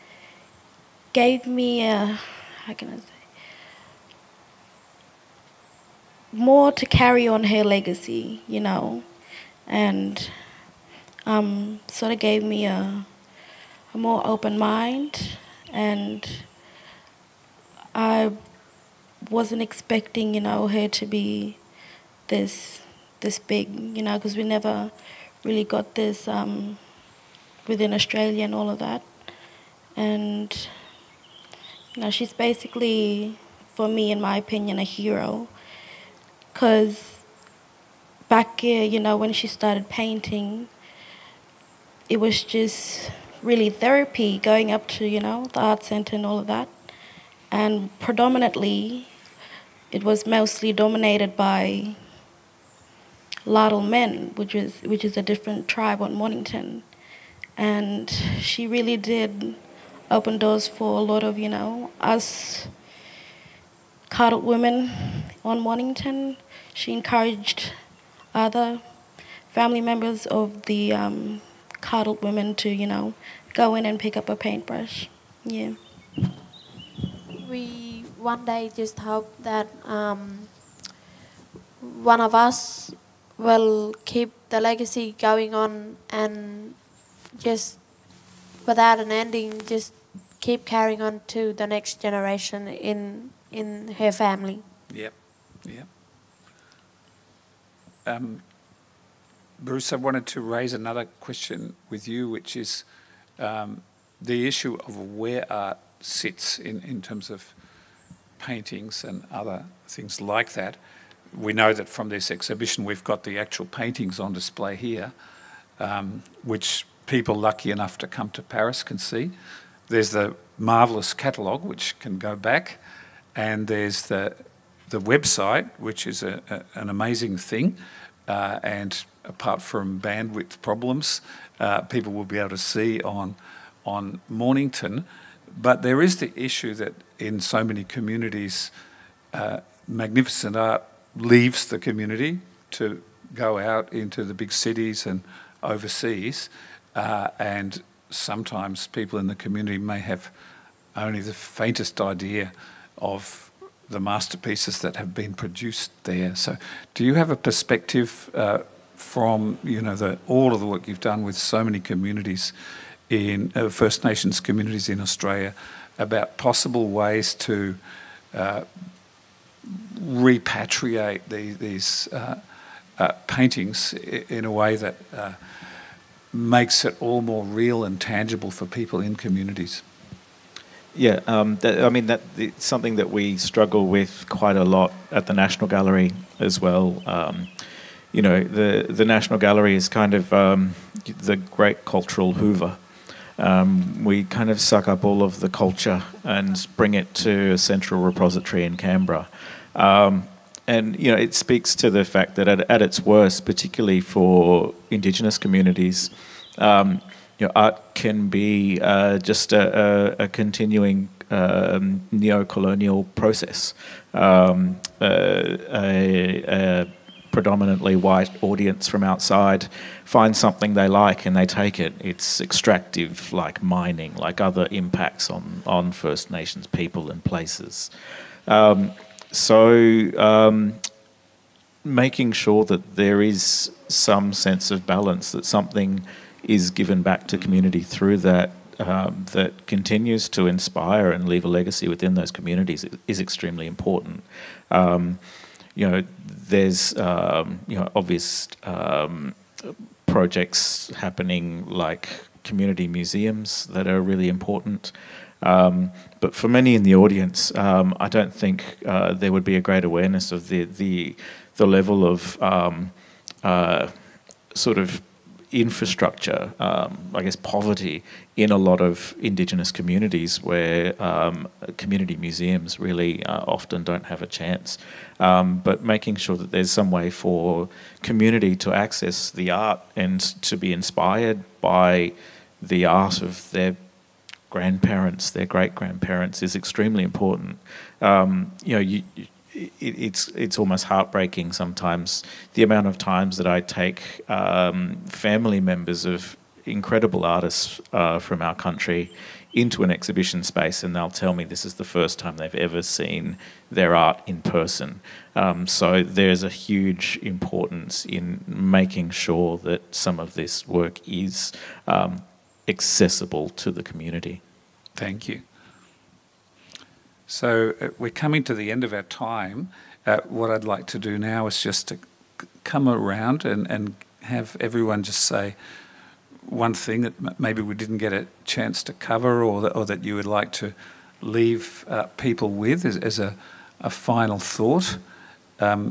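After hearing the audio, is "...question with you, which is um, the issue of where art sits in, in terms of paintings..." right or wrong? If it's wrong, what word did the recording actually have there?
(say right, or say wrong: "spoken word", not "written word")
right.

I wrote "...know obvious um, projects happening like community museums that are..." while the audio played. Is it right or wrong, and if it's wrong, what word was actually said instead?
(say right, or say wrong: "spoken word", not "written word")
right.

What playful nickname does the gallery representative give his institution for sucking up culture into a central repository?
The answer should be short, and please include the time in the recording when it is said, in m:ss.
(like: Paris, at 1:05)
the great cultural Hoover, at 3:11.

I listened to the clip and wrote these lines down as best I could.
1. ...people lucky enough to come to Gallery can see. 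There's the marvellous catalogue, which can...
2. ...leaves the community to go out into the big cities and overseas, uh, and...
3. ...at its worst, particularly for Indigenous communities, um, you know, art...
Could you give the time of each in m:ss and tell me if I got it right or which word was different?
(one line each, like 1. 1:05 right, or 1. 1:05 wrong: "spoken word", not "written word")
1. 1:57 wrong: "Paris", not "Gallery"
2. 2:21 right
3. 3:22 right.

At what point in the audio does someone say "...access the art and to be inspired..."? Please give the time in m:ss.
4:38.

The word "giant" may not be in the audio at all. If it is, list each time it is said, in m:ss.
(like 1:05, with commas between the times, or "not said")
not said.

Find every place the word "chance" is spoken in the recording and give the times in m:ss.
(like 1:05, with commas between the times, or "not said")
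4:34, 5:28.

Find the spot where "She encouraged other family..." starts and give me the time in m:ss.
1:06.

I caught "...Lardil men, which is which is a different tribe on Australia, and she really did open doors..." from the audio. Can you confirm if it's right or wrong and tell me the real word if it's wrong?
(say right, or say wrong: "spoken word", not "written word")
wrong: "Mornington", not "Australia".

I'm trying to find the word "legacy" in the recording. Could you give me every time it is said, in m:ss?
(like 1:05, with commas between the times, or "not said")
0:07, 1:24, 4:01.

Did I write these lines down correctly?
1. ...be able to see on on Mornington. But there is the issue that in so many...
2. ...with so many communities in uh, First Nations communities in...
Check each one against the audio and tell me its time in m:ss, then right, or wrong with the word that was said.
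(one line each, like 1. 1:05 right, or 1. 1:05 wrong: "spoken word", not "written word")
1. 2:12 right
2. 2:41 right.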